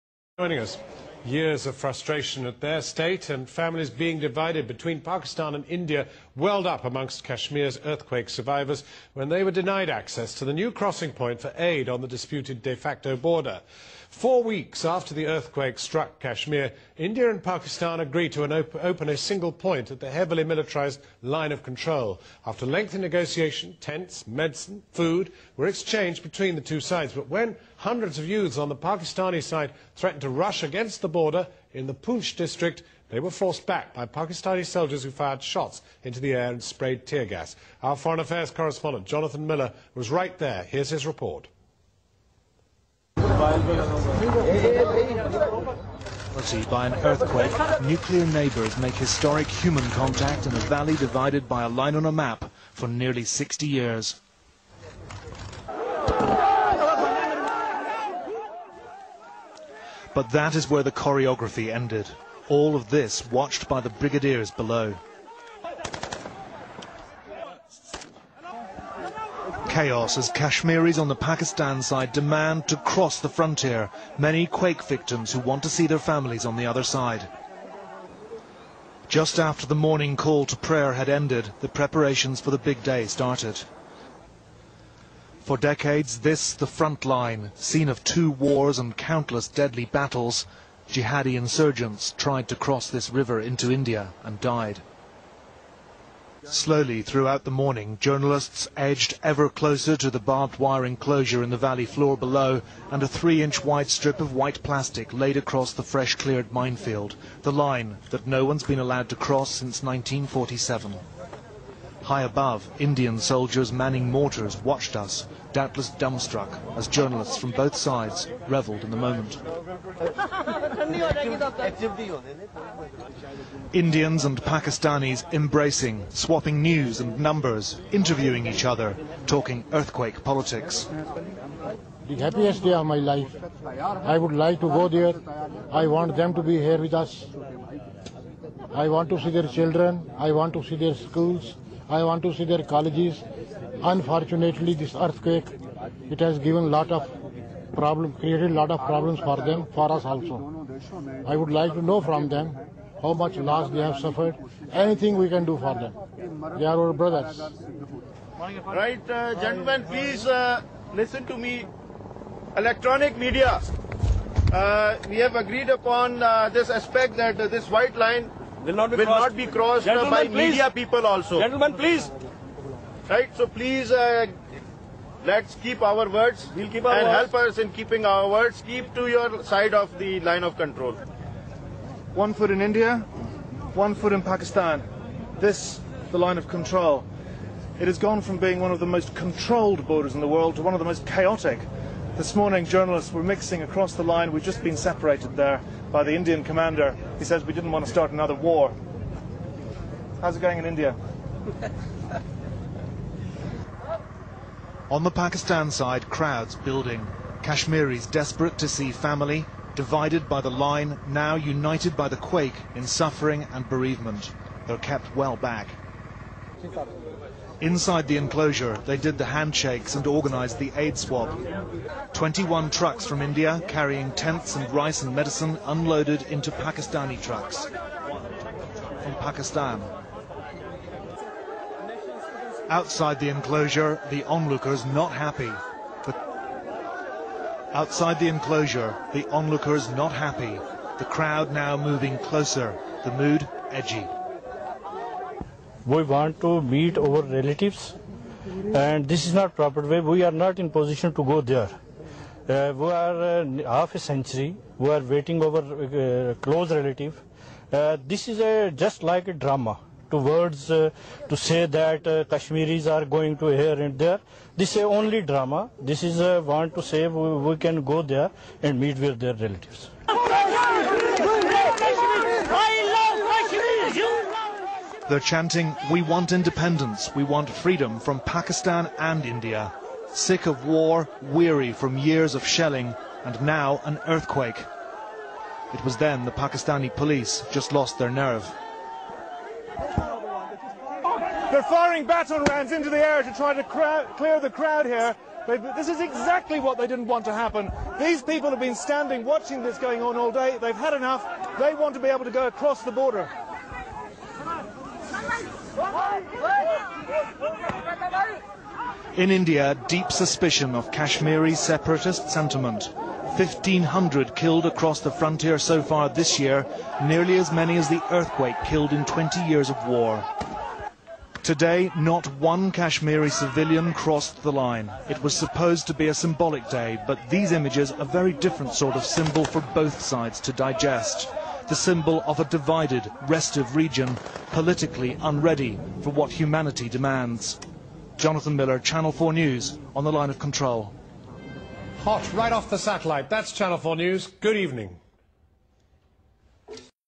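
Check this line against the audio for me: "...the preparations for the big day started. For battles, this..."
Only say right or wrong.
wrong.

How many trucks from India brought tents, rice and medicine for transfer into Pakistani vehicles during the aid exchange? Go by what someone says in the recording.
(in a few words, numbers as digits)
21.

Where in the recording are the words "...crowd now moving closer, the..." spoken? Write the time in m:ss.
4:01.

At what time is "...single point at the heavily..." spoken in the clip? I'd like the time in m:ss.
0:19.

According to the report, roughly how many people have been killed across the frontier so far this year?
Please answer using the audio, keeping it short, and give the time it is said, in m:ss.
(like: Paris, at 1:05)
1,500, at 5:13.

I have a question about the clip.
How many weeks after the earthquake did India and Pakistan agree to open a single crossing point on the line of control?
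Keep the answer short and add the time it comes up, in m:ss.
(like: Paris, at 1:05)
4, at 0:14.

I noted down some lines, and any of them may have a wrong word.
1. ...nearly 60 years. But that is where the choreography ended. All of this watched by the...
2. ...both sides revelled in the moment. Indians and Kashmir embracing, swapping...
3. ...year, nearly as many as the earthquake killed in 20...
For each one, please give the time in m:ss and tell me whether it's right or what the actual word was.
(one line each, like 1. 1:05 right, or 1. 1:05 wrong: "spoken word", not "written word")
1. 0:52 right
2. 1:57 wrong: "Pakistanis", not "Kashmir"
3. 5:16 right.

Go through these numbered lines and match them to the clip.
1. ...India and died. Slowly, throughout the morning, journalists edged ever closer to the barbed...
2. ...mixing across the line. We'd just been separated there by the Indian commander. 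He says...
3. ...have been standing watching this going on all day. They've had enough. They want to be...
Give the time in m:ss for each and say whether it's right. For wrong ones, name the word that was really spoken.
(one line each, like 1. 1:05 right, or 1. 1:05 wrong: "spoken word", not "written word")
1. 1:33 right
2. 3:13 right
3. 4:58 right.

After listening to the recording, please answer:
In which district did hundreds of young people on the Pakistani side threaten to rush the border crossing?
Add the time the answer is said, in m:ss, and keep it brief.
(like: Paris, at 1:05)
Poonch, at 0:31.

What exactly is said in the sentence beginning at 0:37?
Our foreign affairs correspondent, Jonathan Miller, was right there.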